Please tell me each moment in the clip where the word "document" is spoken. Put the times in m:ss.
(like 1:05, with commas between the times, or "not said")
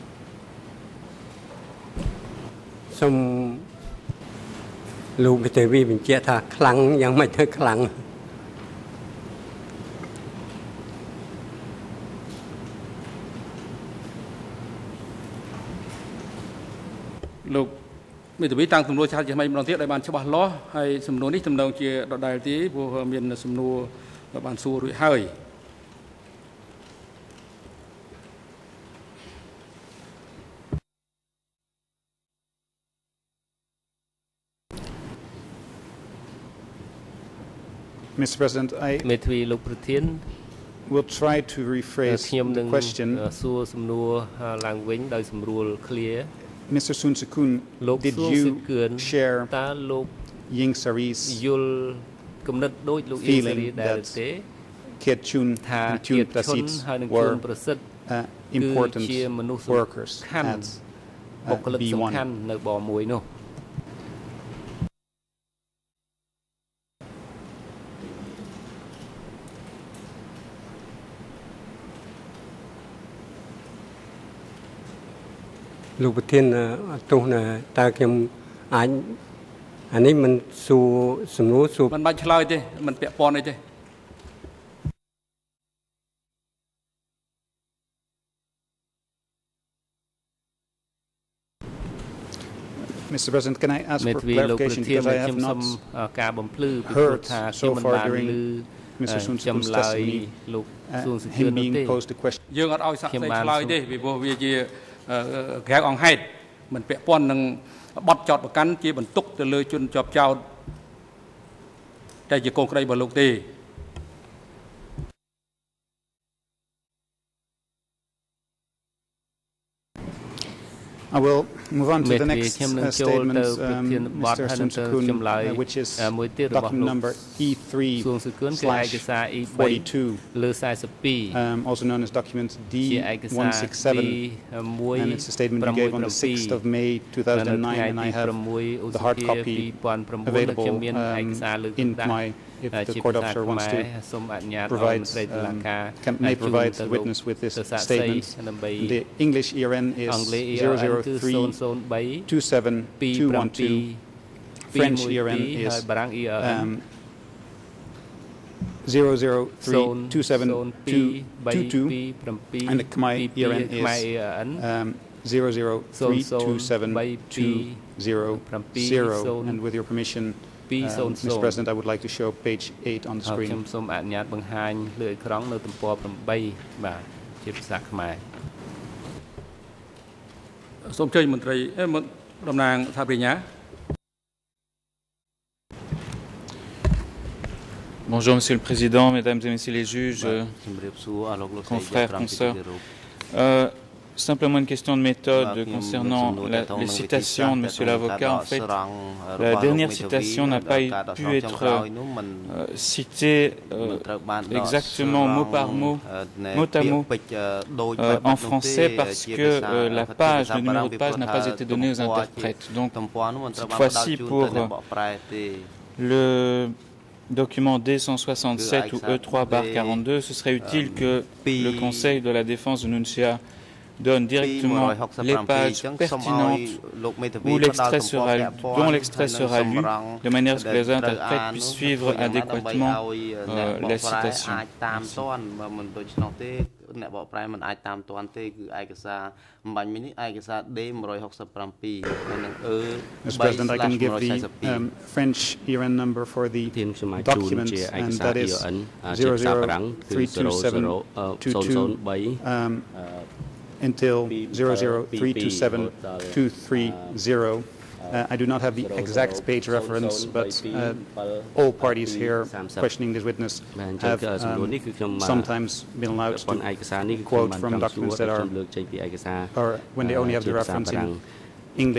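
2:12, 3:37, 4:06, 4:27.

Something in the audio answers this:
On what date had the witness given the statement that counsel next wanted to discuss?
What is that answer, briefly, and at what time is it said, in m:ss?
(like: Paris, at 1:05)
6 May 2009, at 2:16.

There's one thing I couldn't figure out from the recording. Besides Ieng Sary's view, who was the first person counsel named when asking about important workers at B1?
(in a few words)
Keat Chhon.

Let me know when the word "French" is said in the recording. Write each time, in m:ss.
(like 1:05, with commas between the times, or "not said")
2:34, 4:05.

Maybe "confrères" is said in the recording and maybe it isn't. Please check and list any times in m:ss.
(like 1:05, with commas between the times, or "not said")
3:11.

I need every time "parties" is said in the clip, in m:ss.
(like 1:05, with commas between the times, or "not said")
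4:21.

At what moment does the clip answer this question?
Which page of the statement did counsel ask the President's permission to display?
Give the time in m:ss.
2:52.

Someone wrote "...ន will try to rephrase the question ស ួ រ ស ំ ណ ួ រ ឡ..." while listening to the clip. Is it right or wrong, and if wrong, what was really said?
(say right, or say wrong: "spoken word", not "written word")
right.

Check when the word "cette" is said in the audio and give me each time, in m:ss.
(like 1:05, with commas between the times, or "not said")
3:33.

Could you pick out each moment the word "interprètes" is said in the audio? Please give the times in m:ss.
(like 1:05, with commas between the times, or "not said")
3:32, 3:50.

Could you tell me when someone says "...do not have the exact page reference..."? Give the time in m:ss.
4:18.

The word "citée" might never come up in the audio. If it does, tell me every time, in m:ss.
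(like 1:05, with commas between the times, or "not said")
3:22.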